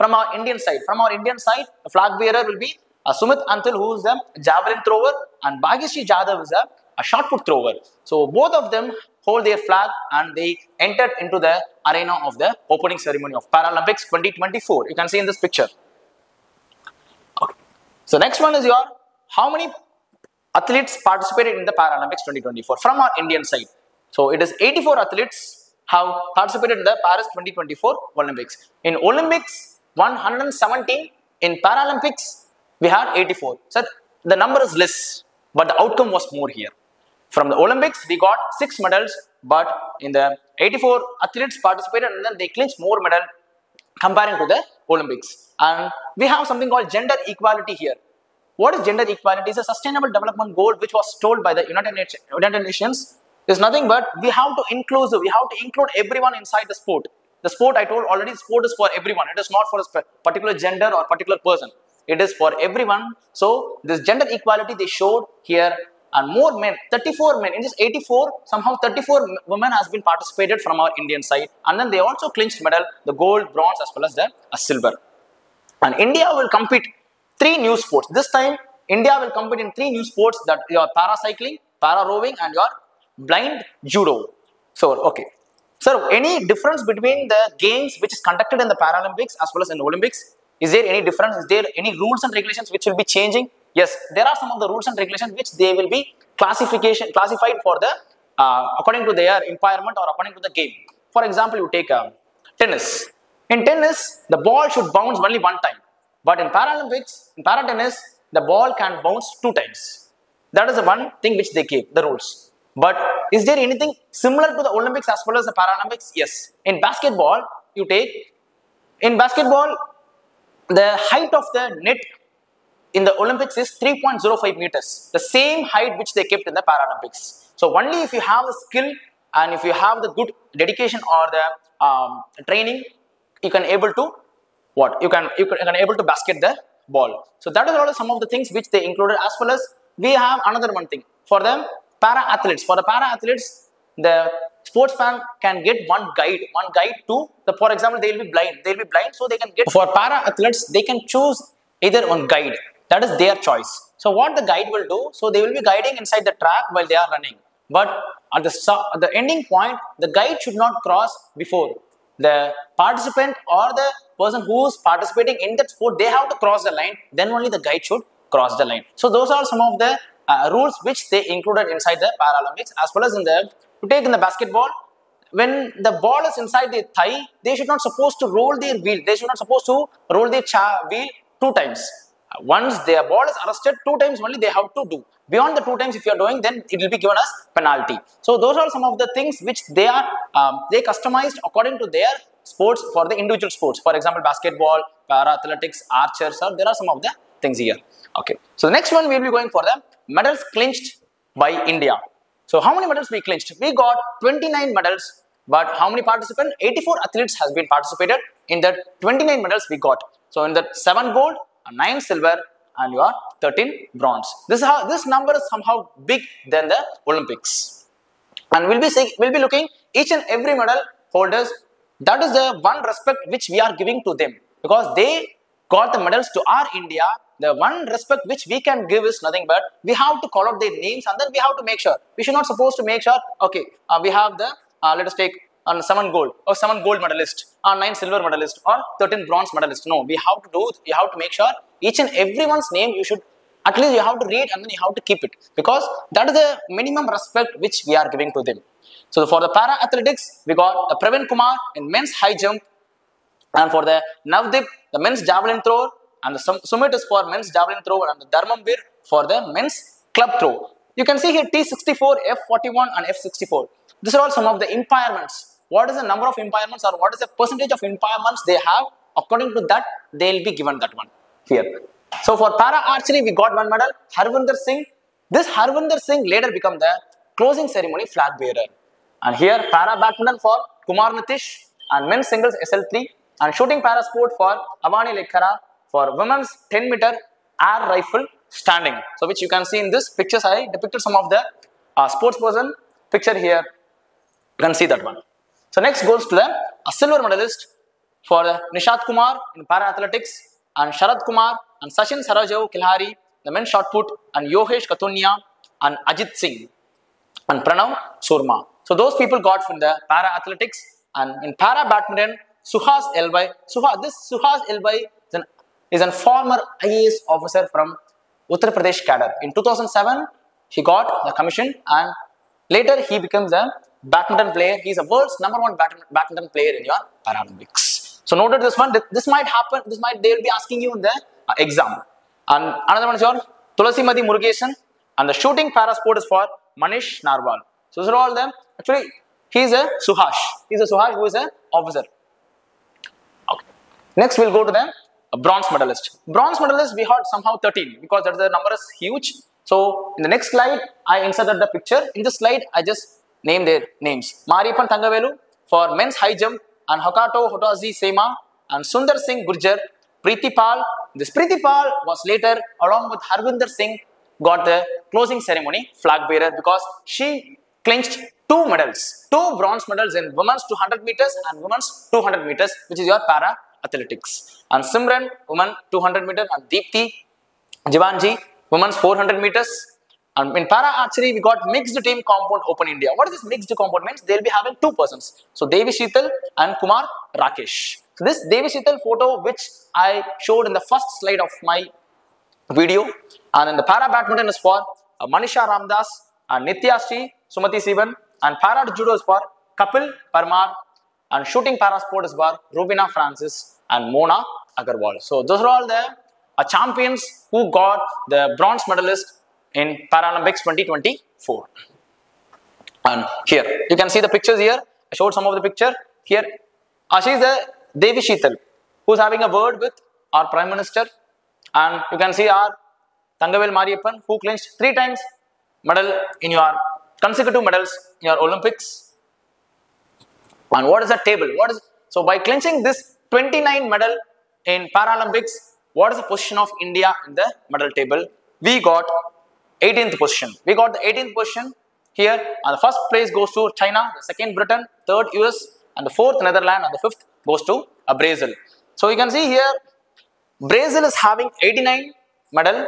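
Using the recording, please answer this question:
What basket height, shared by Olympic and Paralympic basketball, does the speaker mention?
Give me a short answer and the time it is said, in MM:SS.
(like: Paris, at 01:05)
3.05 meters, at 02:03.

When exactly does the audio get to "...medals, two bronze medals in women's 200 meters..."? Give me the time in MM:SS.
06:08.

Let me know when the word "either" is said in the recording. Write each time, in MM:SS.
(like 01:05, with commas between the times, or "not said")
02:31.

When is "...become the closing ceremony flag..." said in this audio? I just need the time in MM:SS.
04:36.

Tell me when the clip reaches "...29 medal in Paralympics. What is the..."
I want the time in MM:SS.
07:13.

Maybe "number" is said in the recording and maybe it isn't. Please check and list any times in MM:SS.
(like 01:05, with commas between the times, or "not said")
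00:34, 03:35, 04:26, 05:25, 05:48.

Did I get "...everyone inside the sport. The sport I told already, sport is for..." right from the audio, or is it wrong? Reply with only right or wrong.
right.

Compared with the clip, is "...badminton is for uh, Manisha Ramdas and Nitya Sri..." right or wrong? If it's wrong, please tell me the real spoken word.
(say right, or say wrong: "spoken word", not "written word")
right.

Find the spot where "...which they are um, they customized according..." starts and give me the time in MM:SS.
03:09.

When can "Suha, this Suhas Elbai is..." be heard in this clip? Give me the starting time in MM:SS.
05:13.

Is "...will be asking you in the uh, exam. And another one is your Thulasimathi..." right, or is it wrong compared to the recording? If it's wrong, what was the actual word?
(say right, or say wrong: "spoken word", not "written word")
right.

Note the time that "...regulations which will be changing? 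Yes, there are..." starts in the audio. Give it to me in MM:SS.
01:32.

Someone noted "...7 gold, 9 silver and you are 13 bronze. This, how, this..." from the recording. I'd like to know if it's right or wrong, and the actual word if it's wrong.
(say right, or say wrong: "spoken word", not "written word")
right.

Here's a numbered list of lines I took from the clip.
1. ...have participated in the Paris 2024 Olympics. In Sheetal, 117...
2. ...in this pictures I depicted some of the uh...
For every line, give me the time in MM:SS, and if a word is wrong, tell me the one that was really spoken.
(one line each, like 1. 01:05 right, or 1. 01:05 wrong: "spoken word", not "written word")
1. 00:25 wrong: "Olympics", not "Sheetal"
2. 04:49 right.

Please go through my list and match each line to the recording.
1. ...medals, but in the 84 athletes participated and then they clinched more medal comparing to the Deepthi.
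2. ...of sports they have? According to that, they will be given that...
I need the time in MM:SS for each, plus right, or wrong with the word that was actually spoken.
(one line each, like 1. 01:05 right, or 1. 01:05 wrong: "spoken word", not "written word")
1. 00:38 wrong: "Olympics", not "Deepthi"
2. 04:27 wrong: "impairments", not "sports".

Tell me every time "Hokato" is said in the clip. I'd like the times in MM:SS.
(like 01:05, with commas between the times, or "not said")
05:57.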